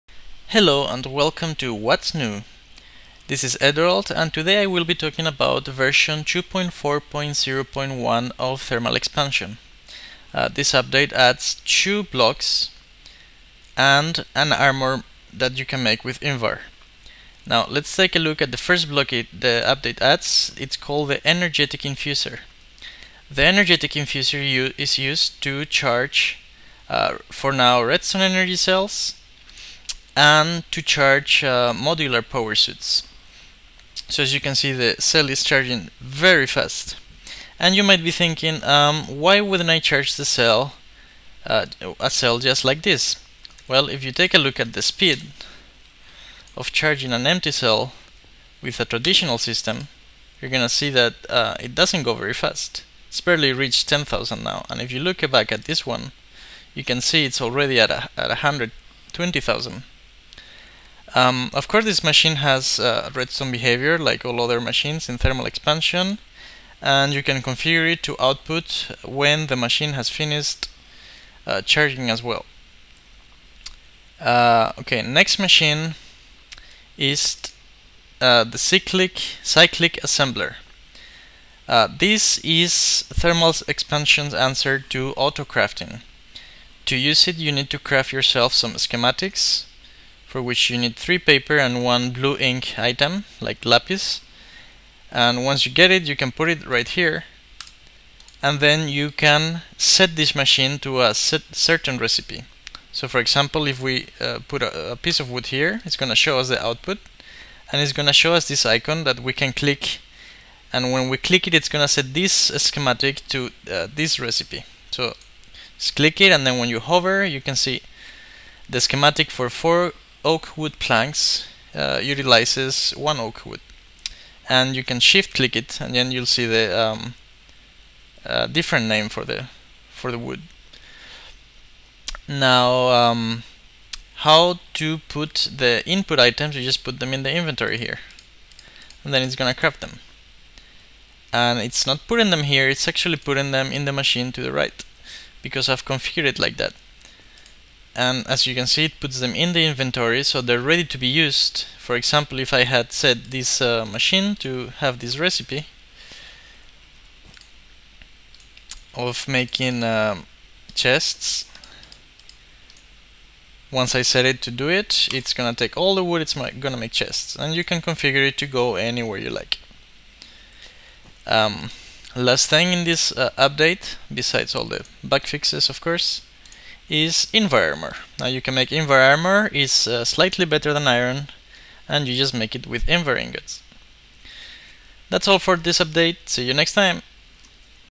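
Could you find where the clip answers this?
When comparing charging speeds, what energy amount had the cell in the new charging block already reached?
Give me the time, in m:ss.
0:58.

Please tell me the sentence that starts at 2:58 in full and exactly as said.
Now you can make Invar Armor, it's uh, slightly better than iron, and you just make it with Invar ingots.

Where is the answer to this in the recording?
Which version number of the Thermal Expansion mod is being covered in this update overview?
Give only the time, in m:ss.
0:06.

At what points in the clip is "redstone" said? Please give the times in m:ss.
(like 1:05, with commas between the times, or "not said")
0:27, 1:03.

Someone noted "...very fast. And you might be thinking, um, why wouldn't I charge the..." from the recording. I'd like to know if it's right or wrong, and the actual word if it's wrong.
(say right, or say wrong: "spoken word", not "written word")
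right.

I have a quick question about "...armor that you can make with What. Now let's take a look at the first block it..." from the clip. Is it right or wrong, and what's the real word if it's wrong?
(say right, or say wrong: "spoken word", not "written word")
wrong: "Invar", not "What".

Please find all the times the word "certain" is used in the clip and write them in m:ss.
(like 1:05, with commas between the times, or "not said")
1:41.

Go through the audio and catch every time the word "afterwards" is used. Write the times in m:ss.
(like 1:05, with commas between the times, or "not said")
not said.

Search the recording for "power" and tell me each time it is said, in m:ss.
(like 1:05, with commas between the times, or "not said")
0:32.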